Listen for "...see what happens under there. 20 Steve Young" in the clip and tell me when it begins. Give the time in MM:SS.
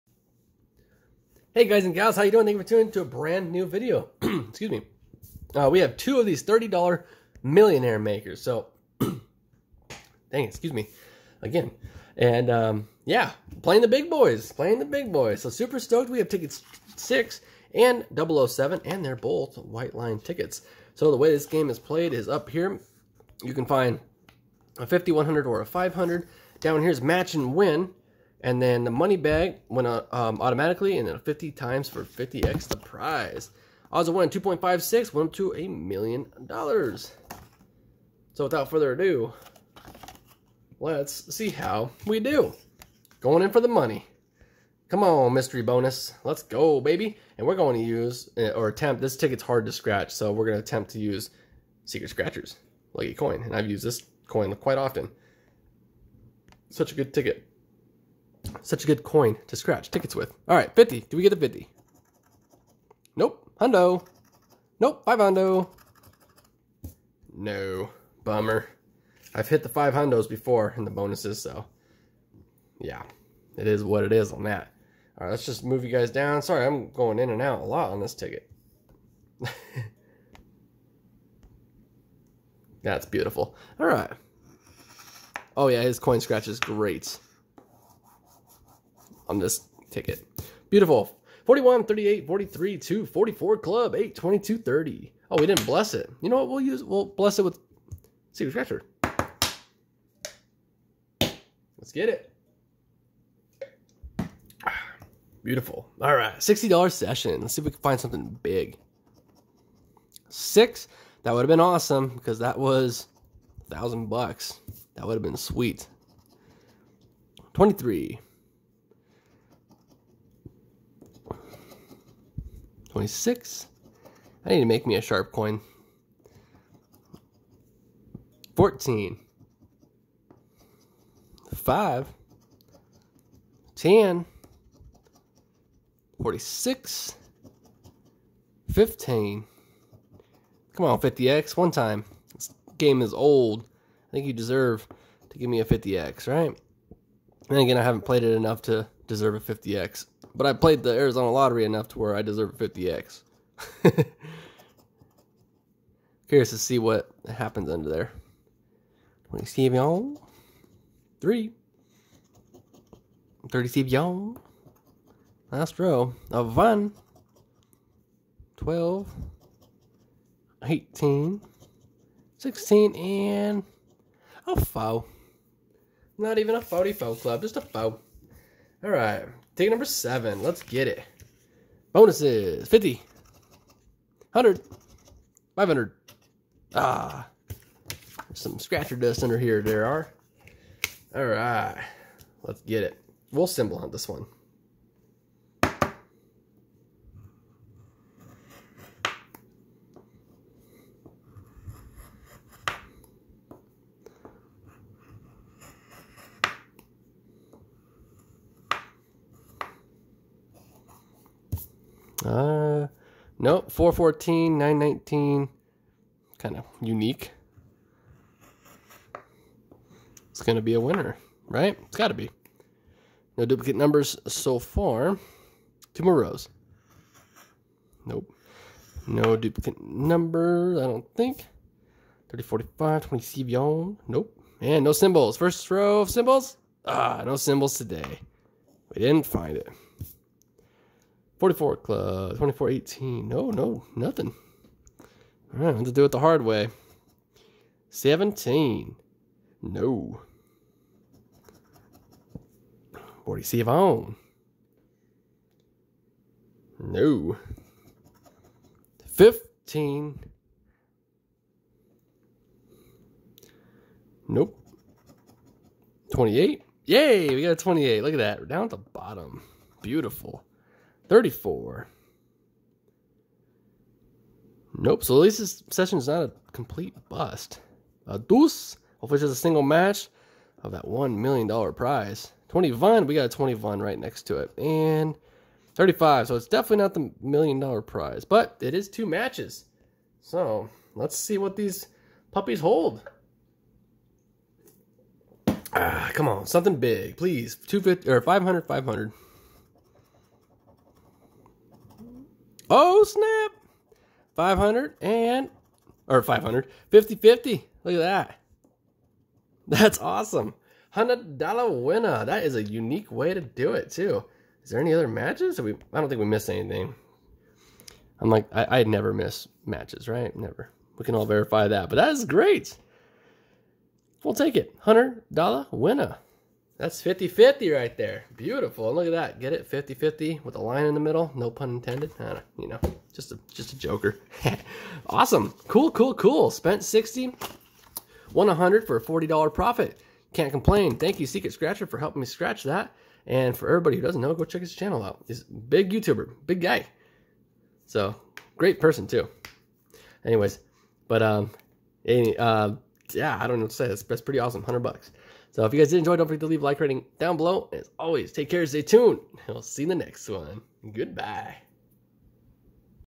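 02:36.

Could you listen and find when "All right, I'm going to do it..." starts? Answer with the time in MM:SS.
04:04.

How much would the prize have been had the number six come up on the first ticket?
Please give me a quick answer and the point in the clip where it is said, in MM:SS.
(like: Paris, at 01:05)
$1,000, at 01:53.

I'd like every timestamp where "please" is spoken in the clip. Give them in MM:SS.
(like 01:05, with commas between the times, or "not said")
04:57.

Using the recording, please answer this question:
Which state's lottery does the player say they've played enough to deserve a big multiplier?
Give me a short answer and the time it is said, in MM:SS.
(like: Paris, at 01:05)
Arizona, at 02:30.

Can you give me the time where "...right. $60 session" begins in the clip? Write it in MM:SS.
01:46.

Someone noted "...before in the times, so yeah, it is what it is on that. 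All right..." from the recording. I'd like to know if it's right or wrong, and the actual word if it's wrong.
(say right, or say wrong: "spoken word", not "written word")
wrong: "bonuses", not "times".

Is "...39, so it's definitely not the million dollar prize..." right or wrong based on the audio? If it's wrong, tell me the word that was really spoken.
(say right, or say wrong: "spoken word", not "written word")
wrong: "35", not "39".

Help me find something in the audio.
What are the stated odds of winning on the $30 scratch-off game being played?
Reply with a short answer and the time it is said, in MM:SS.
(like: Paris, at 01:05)
2.56, at 00:34.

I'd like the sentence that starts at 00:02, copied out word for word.
Thank you for tuning to a brand new video.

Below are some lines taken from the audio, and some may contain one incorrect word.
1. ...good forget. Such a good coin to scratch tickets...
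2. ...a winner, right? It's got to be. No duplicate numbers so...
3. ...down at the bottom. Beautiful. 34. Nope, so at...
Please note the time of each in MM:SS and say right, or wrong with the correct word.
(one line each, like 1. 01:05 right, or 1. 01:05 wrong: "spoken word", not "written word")
1. 00:56 wrong: "ticket", not "forget"
2. 03:40 right
3. 04:28 right.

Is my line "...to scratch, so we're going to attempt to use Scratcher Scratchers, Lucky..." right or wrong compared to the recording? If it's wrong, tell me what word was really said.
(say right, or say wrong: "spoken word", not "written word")
wrong: "Secret", not "Scratcher".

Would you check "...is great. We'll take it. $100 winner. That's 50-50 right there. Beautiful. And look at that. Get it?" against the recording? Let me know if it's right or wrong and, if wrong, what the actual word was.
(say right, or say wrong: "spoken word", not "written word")
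right.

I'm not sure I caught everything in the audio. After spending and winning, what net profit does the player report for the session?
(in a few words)
$40.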